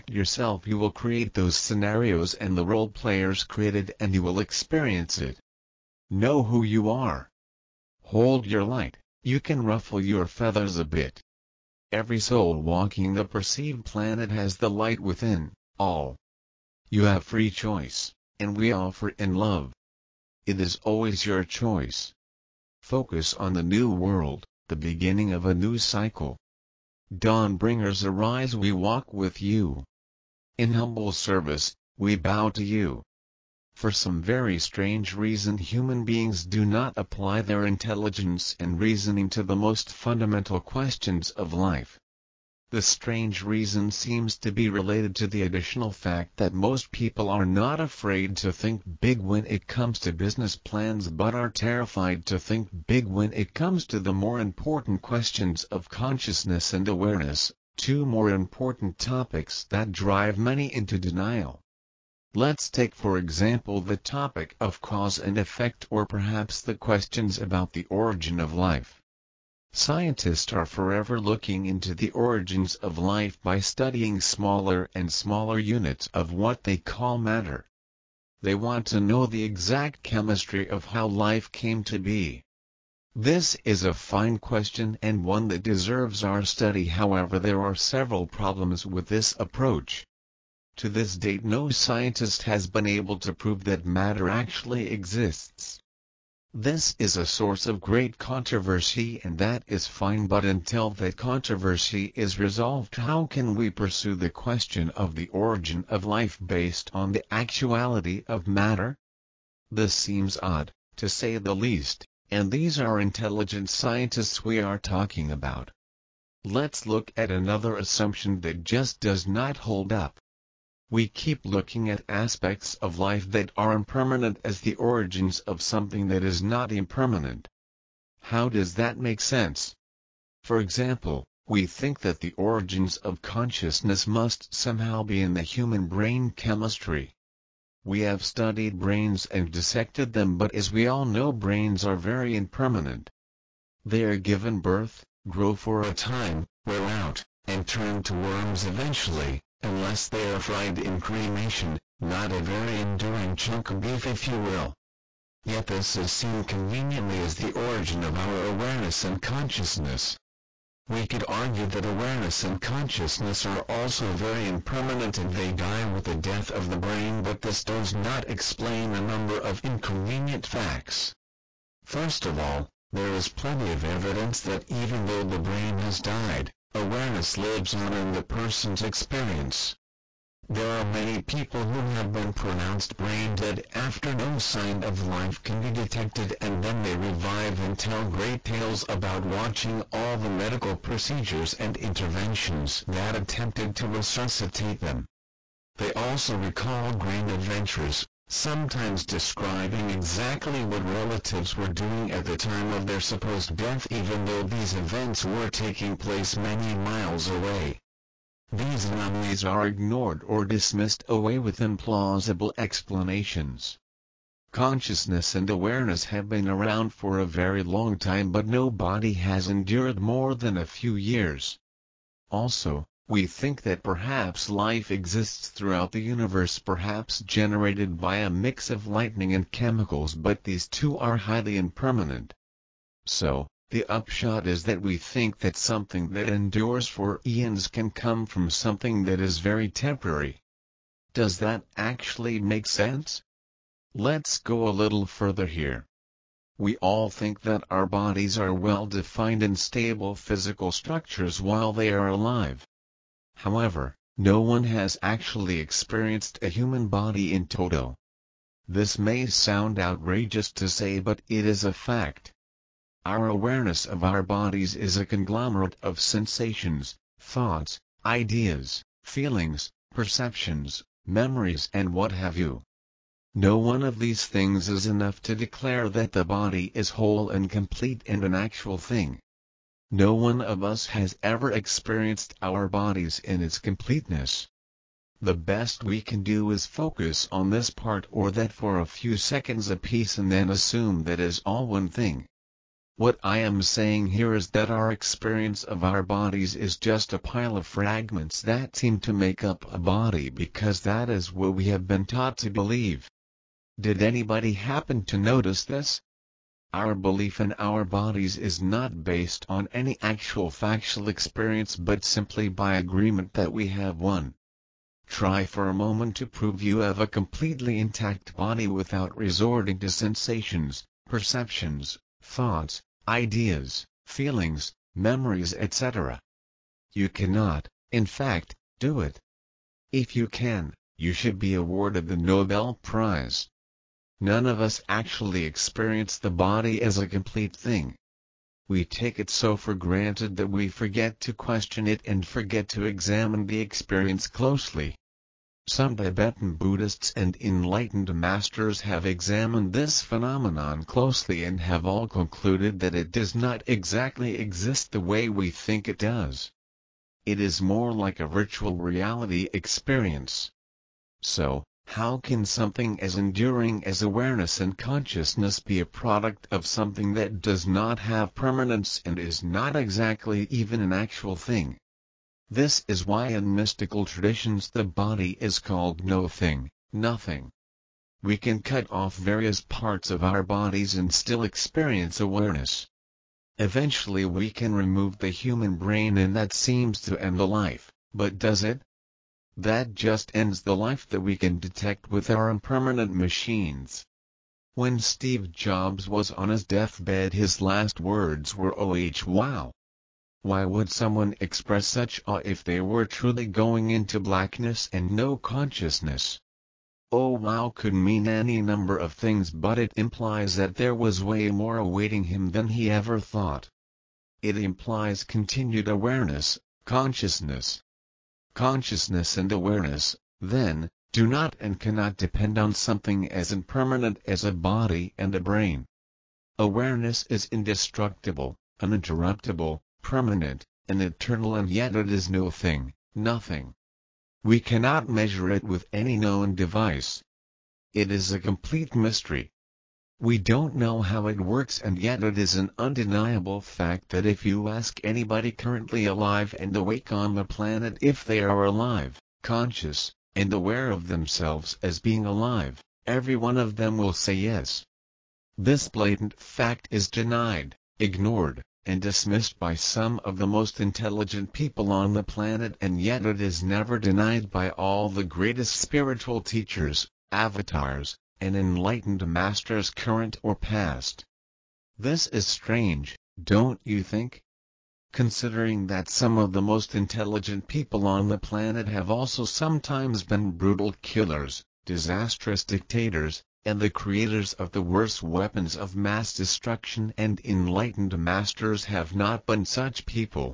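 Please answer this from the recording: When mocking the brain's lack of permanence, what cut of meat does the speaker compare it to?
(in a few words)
Chunk of beef.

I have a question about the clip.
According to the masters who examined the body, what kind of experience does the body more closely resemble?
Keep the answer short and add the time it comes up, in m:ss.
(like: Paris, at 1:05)
Virtual reality, at 5:58.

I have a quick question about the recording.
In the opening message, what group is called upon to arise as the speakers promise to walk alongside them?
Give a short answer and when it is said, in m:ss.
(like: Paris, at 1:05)
Dawn bringers, at 0:27.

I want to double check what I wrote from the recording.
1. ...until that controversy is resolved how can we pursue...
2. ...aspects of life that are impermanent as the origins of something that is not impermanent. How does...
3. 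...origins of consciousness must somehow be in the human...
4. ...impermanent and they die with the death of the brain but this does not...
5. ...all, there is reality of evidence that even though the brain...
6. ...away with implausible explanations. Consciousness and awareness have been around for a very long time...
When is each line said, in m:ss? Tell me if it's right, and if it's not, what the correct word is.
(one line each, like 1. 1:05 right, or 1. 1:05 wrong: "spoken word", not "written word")
1. 1:40 right
2. 2:02 right
3. 2:12 right
4. 2:44 right
5. 2:52 wrong: "plenty", not "reality"
6. 3:31 right.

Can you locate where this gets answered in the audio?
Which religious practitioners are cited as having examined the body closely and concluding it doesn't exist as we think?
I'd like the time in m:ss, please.
5:45.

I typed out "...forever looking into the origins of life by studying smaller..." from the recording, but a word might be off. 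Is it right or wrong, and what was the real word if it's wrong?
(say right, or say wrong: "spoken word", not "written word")
right.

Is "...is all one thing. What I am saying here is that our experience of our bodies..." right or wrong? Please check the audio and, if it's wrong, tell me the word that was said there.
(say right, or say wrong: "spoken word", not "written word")
right.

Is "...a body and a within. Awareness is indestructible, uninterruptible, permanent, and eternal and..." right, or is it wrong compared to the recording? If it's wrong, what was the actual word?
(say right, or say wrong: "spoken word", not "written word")
wrong: "brain", not "within".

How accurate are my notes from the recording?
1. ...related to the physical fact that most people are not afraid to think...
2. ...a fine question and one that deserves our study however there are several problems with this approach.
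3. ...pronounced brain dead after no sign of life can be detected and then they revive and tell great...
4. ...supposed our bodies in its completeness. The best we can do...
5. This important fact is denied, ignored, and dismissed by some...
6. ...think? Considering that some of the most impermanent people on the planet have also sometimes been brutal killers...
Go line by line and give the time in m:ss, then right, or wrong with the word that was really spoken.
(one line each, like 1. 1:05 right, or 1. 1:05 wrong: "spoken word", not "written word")
1. 0:44 wrong: "additional", not "physical"
2. 1:23 right
3. 3:02 right
4. 4:41 wrong: "experienced", not "supposed"
5. 7:35 wrong: "blatant", not "important"
6. 7:54 wrong: "intelligent", not "impermanent".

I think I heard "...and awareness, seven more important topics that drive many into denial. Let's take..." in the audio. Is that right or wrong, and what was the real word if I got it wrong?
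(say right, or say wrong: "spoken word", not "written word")
wrong: "two", not "seven".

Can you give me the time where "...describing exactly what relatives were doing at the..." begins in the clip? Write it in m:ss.
3:19.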